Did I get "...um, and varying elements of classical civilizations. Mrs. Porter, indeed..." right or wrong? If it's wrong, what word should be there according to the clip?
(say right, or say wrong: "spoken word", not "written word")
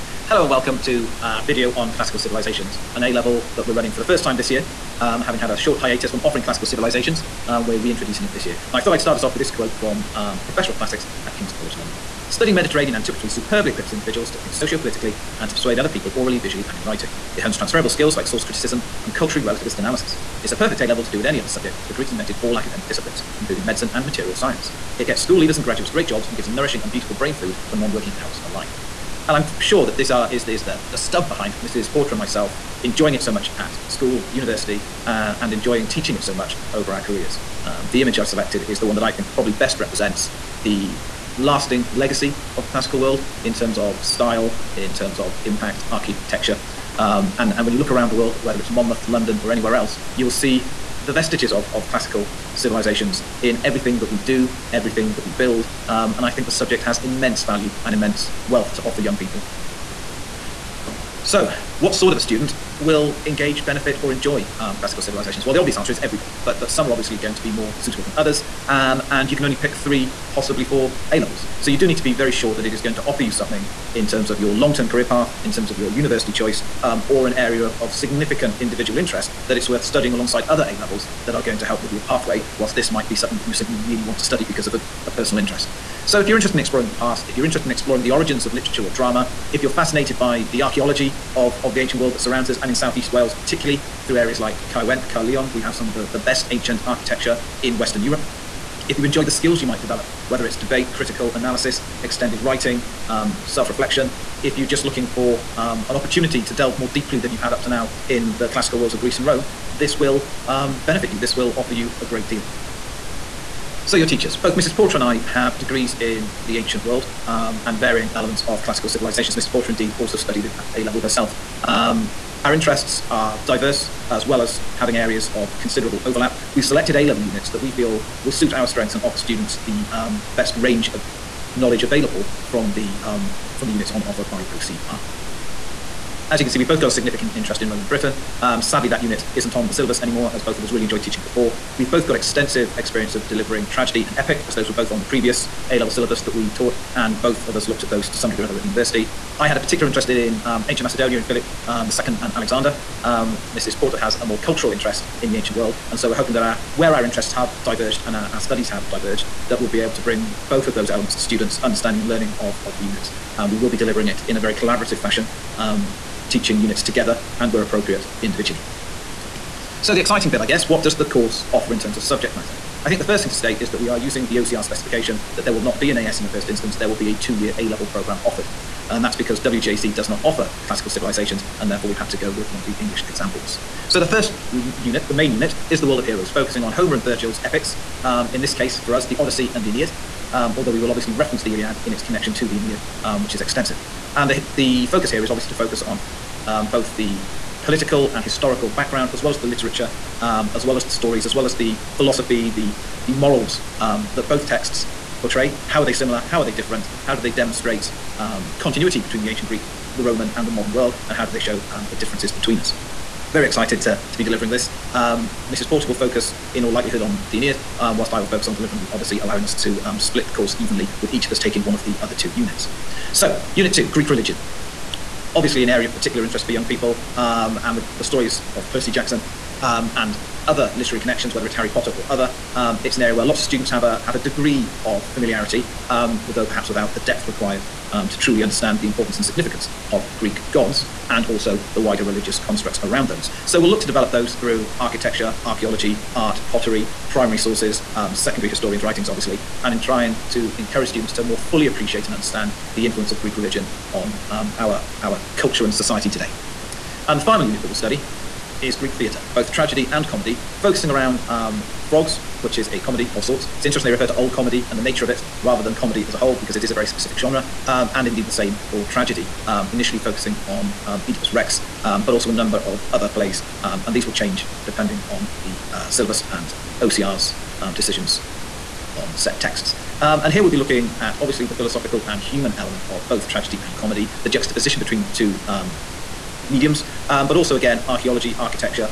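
right.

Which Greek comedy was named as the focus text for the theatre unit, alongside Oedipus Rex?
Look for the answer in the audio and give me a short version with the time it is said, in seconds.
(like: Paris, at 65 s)
Frogs, at 261 s.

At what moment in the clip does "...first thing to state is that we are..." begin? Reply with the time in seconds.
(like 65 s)
173 s.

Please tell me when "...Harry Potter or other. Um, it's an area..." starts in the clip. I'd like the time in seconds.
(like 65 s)
231 s.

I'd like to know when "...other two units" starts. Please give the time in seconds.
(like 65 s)
222 s.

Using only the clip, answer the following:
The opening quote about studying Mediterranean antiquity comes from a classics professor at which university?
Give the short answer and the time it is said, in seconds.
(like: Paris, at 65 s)
King's College London, at 11 s.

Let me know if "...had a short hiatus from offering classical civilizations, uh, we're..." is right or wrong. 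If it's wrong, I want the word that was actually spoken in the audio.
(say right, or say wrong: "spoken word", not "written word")
right.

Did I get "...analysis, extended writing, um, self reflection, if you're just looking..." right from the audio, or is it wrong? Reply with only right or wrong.
right.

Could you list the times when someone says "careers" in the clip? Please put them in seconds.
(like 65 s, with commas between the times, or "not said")
37 s, 74 s.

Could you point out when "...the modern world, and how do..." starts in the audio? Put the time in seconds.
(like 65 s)
210 s.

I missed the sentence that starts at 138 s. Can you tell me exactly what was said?
Um, sadly, that unit isn't on the syllabus anymore, as both of us really enjoyed teaching before.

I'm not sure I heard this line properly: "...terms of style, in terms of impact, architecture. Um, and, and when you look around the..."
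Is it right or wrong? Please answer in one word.
right.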